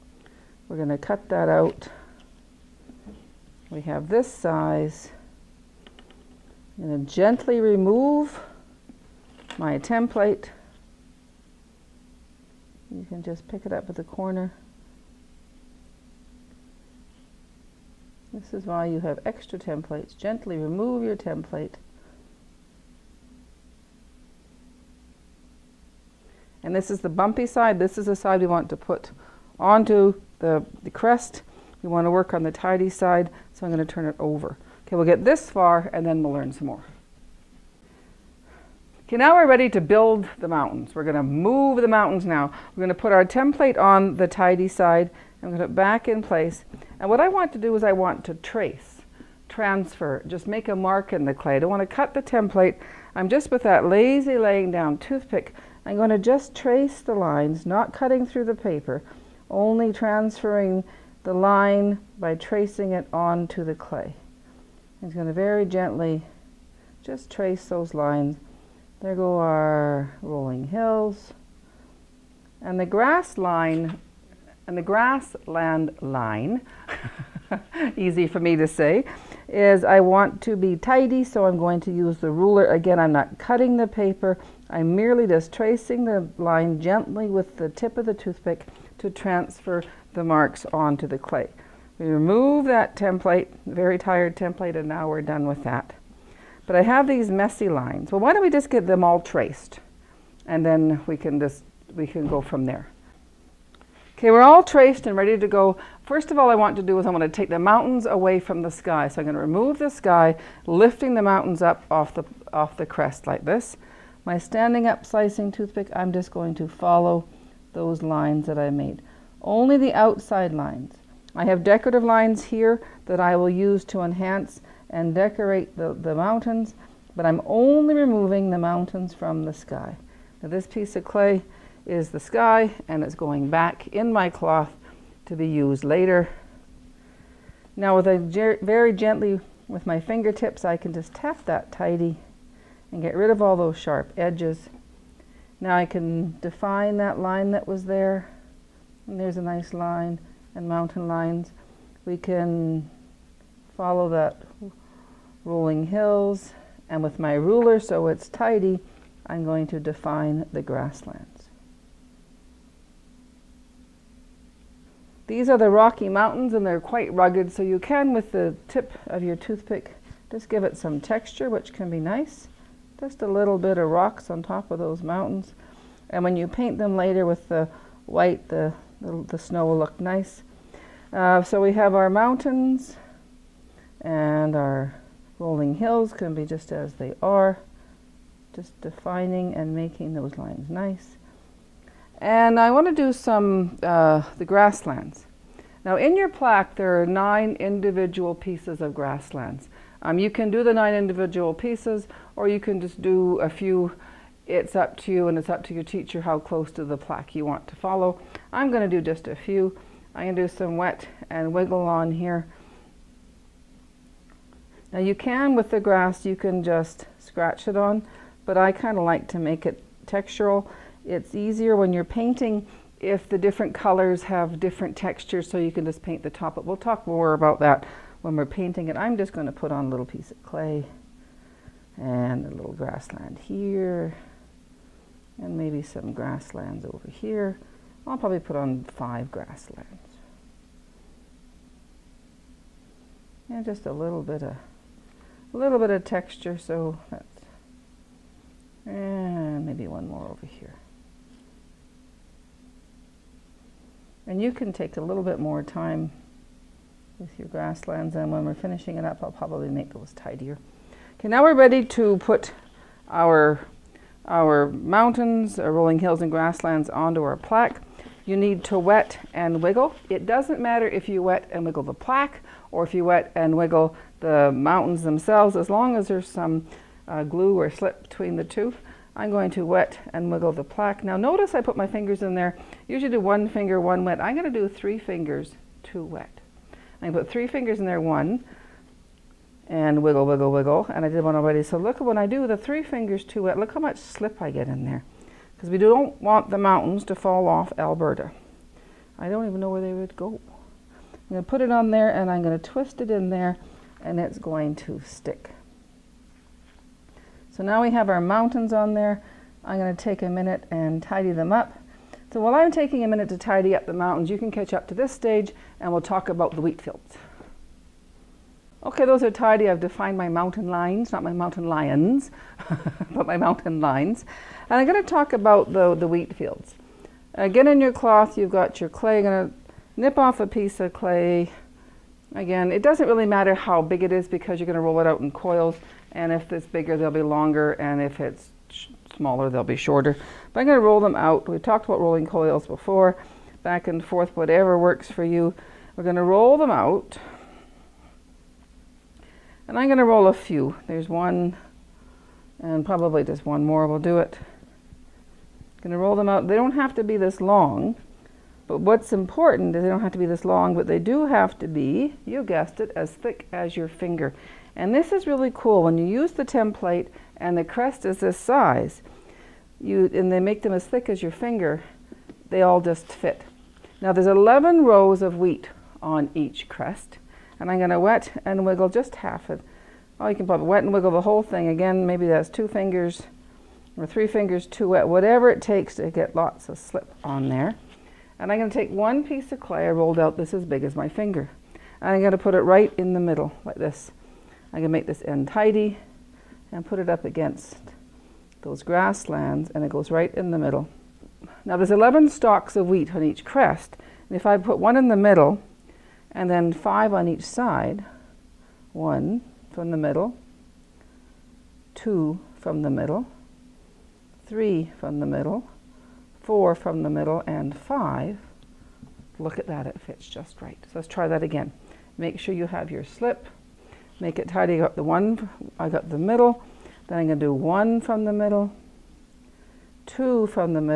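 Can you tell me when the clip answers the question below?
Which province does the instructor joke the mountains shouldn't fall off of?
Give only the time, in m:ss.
4:57.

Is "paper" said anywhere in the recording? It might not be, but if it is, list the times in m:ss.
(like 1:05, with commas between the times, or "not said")
0:58, 1:23.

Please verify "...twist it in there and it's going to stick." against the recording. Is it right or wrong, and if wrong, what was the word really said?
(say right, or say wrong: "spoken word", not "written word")
right.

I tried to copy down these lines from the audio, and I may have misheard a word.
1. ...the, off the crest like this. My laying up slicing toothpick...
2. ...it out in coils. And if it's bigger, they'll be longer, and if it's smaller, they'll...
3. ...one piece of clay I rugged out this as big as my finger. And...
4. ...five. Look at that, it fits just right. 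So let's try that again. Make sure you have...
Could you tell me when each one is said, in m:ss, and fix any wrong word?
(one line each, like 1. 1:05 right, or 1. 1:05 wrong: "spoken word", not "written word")
1. 1:52 wrong: "standing", not "laying"
2. 5:34 right
3. 6:28 wrong: "rolled", not "rugged"
4. 6:57 right.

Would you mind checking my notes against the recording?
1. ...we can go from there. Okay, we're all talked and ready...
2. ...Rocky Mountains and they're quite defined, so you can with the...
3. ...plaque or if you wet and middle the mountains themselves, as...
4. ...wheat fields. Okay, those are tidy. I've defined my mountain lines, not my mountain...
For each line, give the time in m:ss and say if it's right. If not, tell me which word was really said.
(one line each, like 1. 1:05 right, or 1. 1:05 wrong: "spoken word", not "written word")
1. 1:41 wrong: "traced", not "talked"
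2. 2:45 wrong: "rugged", not "defined"
3. 4:31 wrong: "wiggle", not "middle"
4. 5:16 right.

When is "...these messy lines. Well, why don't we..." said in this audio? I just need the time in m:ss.
1:37.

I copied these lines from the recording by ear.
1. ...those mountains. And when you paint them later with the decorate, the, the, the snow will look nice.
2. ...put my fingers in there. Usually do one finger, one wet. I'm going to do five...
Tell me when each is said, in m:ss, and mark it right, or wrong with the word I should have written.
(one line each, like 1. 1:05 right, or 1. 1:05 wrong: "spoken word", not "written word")
1. 2:54 wrong: "white", not "decorate"
2. 4:41 wrong: "three", not "five".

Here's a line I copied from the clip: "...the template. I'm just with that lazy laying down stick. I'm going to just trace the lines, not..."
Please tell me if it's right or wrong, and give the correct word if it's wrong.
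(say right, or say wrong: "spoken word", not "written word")
wrong: "toothpick", not "stick".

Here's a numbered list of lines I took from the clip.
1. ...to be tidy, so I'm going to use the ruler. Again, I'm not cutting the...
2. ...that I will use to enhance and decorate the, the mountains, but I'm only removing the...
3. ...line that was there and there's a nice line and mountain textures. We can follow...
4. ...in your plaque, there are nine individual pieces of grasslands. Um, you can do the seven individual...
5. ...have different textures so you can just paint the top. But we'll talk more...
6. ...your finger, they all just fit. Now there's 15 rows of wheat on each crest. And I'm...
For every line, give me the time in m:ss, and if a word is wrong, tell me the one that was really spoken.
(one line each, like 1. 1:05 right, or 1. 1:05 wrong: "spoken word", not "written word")
1. 1:20 right
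2. 2:03 right
3. 2:27 wrong: "lines", not "textures"
4. 3:15 wrong: "nine", not "seven"
5. 3:44 right
6. 6:11 wrong: "11", not "15".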